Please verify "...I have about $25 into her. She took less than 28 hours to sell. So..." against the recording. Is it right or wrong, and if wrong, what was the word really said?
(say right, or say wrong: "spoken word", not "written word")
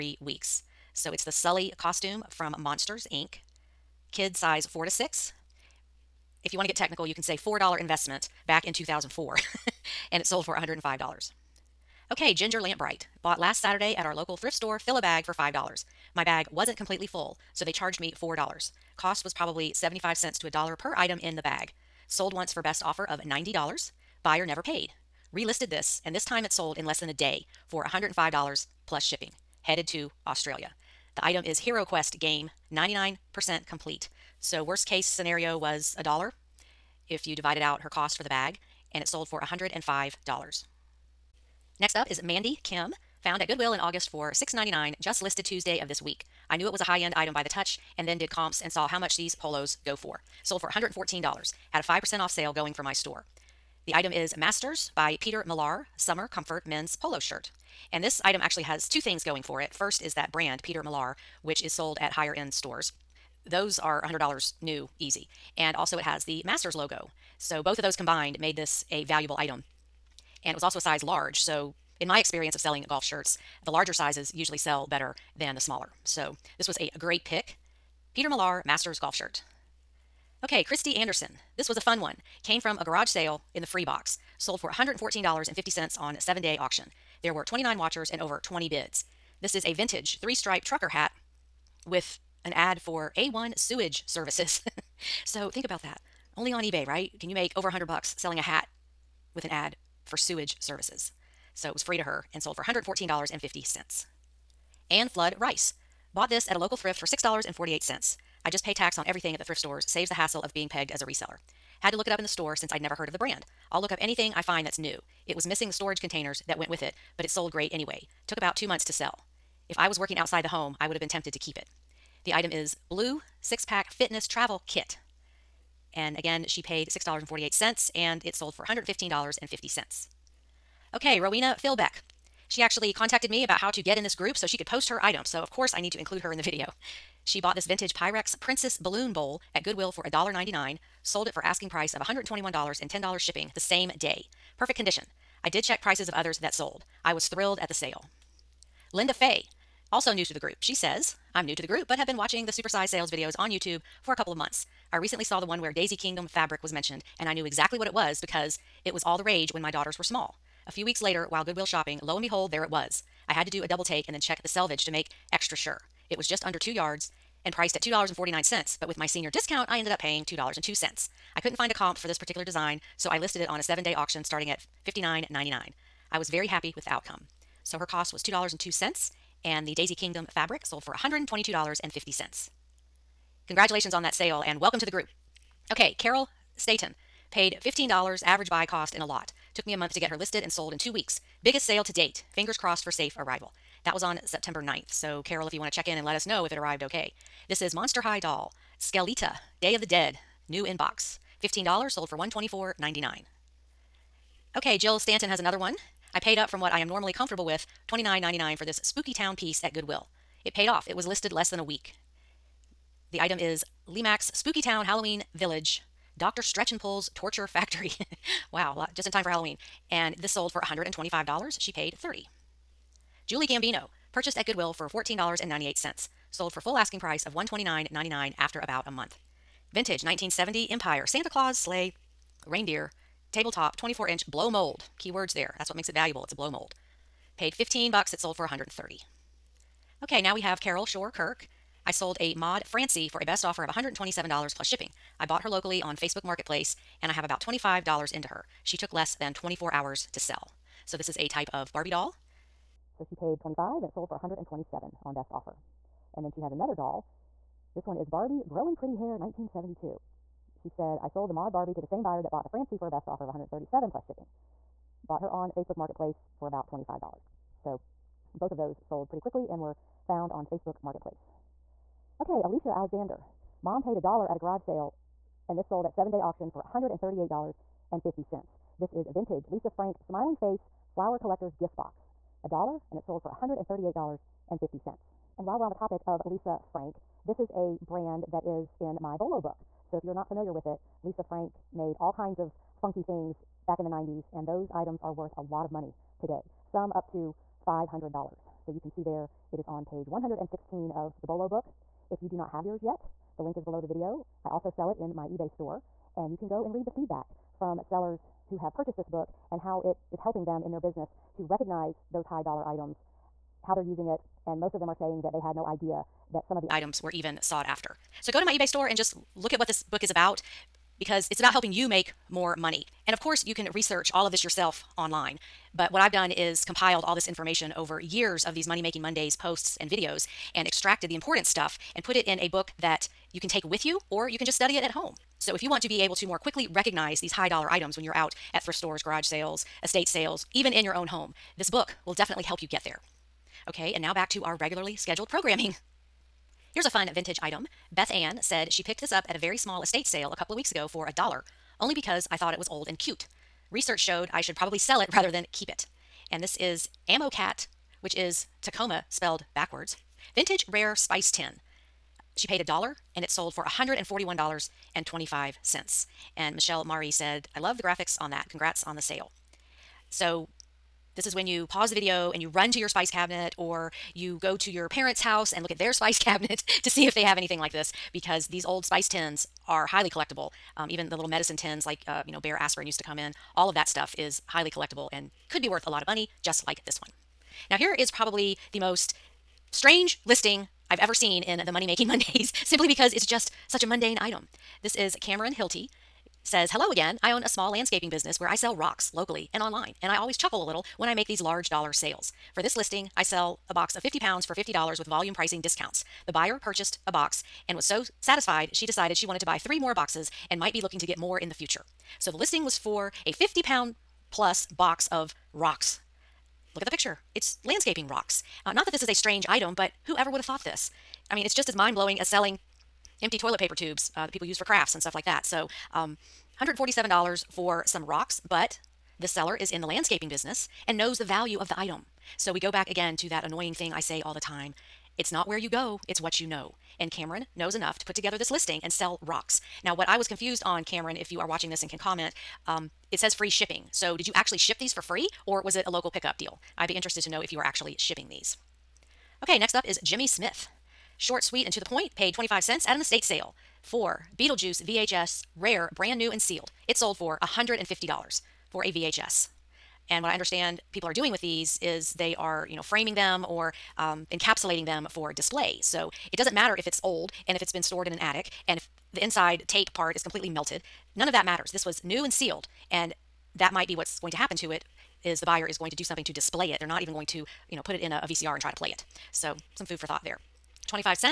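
wrong: "24", not "28".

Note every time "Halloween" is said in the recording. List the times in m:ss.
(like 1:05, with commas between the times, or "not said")
3:34, 3:39.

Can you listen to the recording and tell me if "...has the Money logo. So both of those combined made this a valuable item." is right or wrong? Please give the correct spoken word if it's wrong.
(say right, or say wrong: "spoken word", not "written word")
wrong: "Masters", not "Money".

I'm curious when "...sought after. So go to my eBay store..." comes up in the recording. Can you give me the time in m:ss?
5:17.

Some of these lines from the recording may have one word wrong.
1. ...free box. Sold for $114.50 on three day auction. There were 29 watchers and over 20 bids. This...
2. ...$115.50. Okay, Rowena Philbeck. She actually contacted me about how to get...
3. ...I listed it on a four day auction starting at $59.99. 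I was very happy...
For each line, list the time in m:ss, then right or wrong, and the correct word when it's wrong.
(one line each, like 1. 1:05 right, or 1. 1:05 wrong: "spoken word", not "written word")
1. 1:23 wrong: "seven", not "three"
2. 2:08 right
3. 2:53 wrong: "seven", not "four".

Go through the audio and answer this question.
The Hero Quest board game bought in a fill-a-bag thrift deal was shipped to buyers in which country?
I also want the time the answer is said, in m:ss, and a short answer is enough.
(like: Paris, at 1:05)
Australia, at 0:30.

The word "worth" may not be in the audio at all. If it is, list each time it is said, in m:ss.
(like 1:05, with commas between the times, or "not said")
4:55, 6:25.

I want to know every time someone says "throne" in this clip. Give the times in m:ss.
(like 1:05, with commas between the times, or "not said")
not said.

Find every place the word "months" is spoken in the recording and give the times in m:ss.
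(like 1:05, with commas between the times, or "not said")
1:58, 2:34, 3:09, 3:48.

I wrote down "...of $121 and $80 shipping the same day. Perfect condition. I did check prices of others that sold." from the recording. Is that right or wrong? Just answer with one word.
wrong.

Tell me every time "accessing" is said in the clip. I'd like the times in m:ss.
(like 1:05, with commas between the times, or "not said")
not said.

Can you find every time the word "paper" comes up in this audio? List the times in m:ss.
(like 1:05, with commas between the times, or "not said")
7:03.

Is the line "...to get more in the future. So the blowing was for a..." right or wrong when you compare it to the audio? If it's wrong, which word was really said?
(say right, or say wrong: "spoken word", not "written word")
wrong: "listing", not "blowing".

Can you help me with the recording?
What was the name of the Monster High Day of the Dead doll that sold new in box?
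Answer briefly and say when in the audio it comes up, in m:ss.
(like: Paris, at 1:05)
Skeleta, at 3:18.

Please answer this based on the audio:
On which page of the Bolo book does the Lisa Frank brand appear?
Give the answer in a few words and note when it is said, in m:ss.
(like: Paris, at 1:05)
116, at 4:59.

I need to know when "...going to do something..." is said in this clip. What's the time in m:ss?
7:55.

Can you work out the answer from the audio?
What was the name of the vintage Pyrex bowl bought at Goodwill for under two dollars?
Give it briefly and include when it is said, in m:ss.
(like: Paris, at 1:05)
Princess Balloon Bowl, at 2:18.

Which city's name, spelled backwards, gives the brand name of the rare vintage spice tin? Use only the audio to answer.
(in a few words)
Tacoma.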